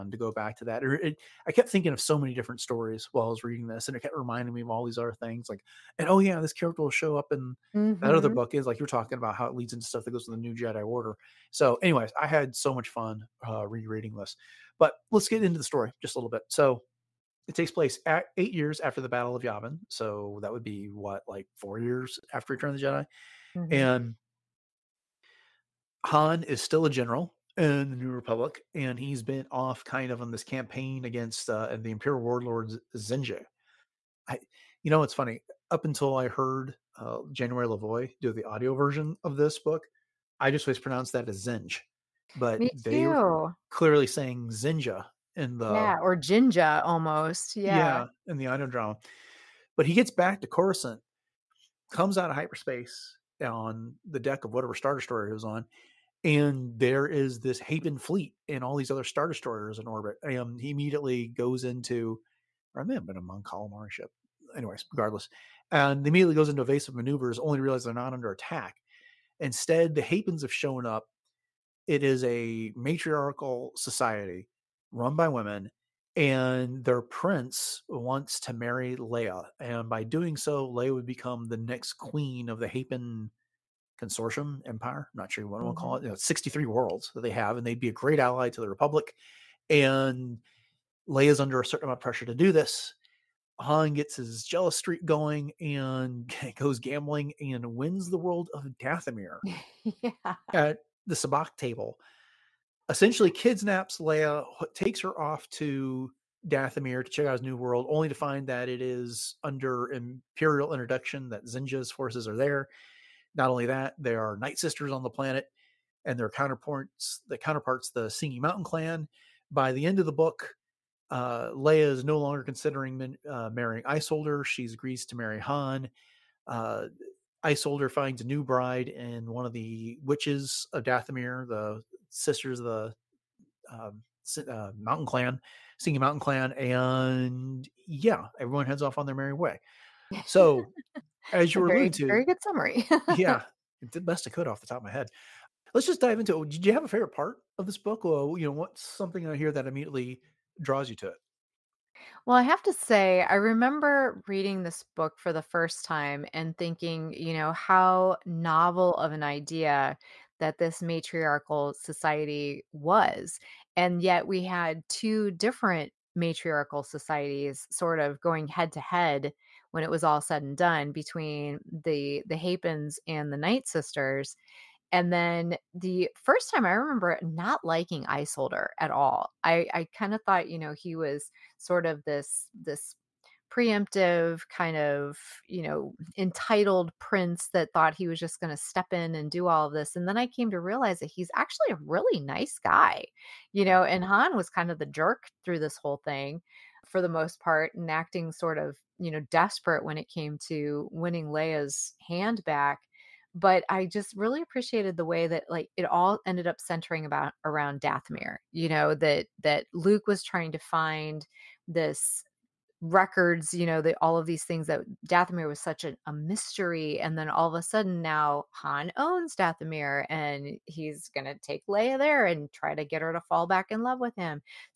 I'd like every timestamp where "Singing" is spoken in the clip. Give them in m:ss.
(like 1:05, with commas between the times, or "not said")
1:58, 2:15.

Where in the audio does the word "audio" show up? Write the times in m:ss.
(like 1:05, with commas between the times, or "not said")
0:38, 0:48.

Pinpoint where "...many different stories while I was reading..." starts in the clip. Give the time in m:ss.
0:02.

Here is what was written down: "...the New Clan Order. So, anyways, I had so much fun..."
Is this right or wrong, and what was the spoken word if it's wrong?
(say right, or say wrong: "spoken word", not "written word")
wrong: "Jedi", not "Clan".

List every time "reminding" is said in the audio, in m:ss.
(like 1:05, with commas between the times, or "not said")
0:04.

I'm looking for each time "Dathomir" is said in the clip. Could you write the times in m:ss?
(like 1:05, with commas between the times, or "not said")
1:38, 1:46, 2:10, 3:27, 3:35, 3:39.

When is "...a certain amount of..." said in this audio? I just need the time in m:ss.
1:31.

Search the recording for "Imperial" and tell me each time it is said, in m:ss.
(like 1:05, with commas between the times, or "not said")
0:31, 1:49.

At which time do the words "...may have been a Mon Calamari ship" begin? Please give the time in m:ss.
1:02.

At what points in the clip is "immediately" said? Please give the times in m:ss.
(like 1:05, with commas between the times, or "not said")
1:00, 1:06, 2:29.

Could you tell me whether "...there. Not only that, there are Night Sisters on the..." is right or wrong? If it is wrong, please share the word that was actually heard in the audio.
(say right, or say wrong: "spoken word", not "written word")
right.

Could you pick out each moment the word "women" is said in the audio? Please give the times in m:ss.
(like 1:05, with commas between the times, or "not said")
1:15.